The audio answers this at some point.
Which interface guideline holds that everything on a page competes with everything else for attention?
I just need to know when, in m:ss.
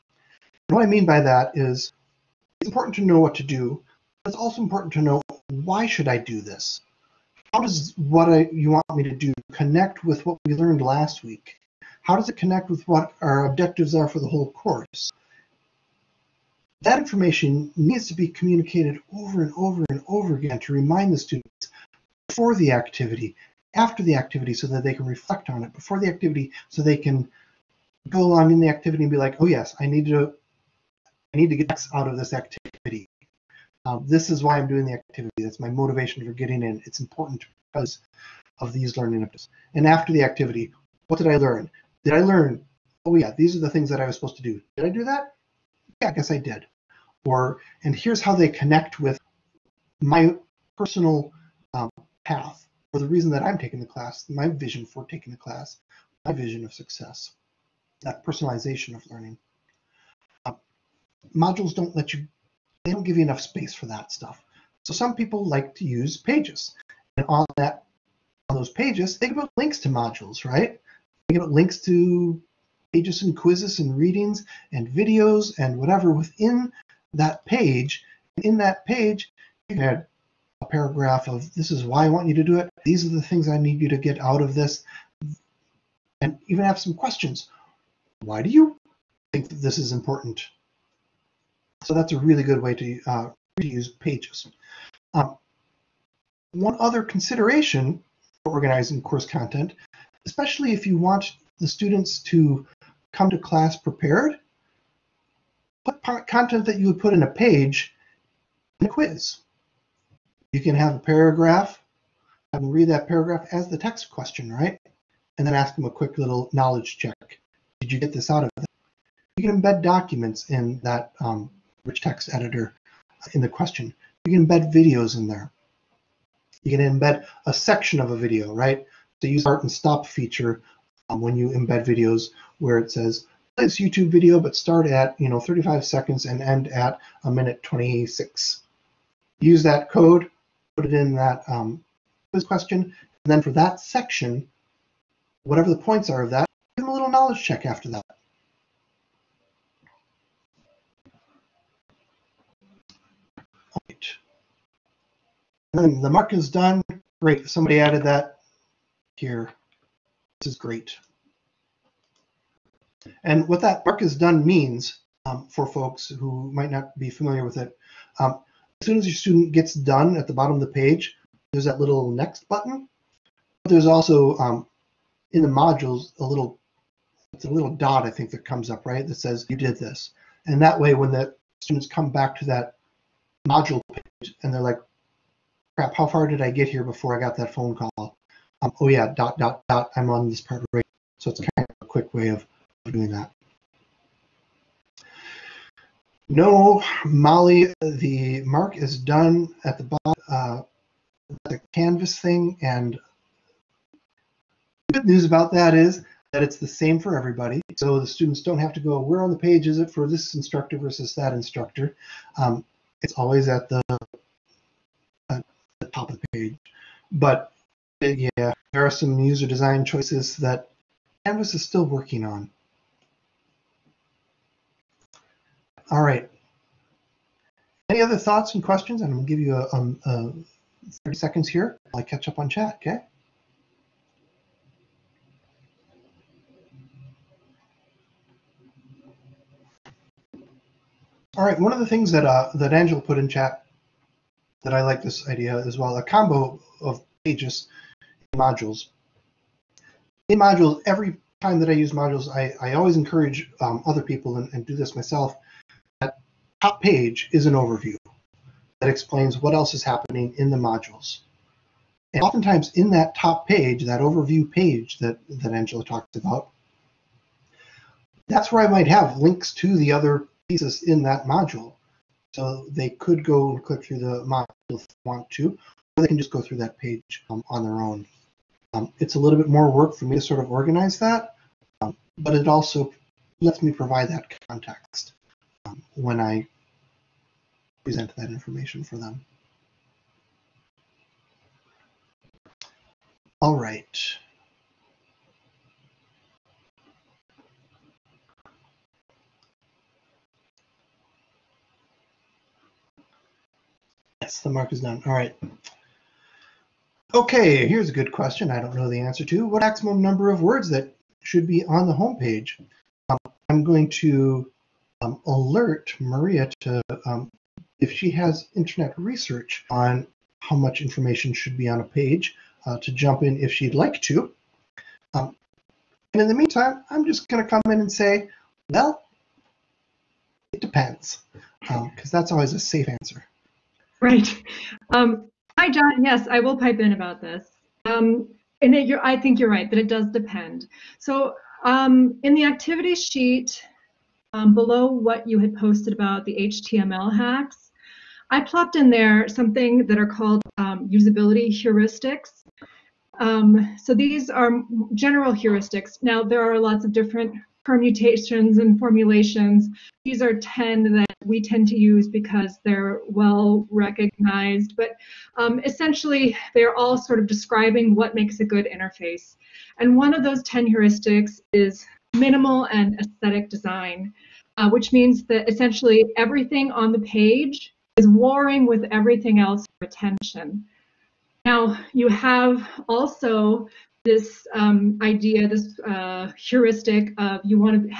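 6:12.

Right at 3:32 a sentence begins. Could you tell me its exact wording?
Um, it's always at the, at the top of the page.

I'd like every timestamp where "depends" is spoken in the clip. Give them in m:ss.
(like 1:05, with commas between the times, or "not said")
5:30, 5:40.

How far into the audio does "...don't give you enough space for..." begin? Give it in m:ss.
1:02.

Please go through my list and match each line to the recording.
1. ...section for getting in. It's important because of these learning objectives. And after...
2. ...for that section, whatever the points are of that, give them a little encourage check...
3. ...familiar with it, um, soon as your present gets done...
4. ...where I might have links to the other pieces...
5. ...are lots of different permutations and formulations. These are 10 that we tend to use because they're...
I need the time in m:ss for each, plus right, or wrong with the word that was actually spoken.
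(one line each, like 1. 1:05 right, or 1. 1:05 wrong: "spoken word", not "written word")
1. 0:35 wrong: "motivation", not "section"
2. 2:23 wrong: "knowledge", not "encourage"
3. 2:47 wrong: "student", not "present"
4. 4:28 right
5. 5:56 right.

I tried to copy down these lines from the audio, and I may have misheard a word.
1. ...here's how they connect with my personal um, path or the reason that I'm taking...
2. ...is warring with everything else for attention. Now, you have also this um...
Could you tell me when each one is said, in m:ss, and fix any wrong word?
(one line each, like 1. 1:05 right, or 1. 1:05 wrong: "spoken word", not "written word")
1. 0:47 right
2. 6:17 right.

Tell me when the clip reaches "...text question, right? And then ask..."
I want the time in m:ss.
1:53.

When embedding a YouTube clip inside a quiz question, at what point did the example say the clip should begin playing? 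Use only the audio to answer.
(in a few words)
35 seconds.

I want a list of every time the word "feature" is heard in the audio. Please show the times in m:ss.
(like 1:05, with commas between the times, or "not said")
2:10.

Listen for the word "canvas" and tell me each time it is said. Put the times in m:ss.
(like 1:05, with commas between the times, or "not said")
3:21, 3:41.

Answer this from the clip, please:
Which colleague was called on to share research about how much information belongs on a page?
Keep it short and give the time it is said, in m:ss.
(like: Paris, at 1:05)
Maria, at 5:15.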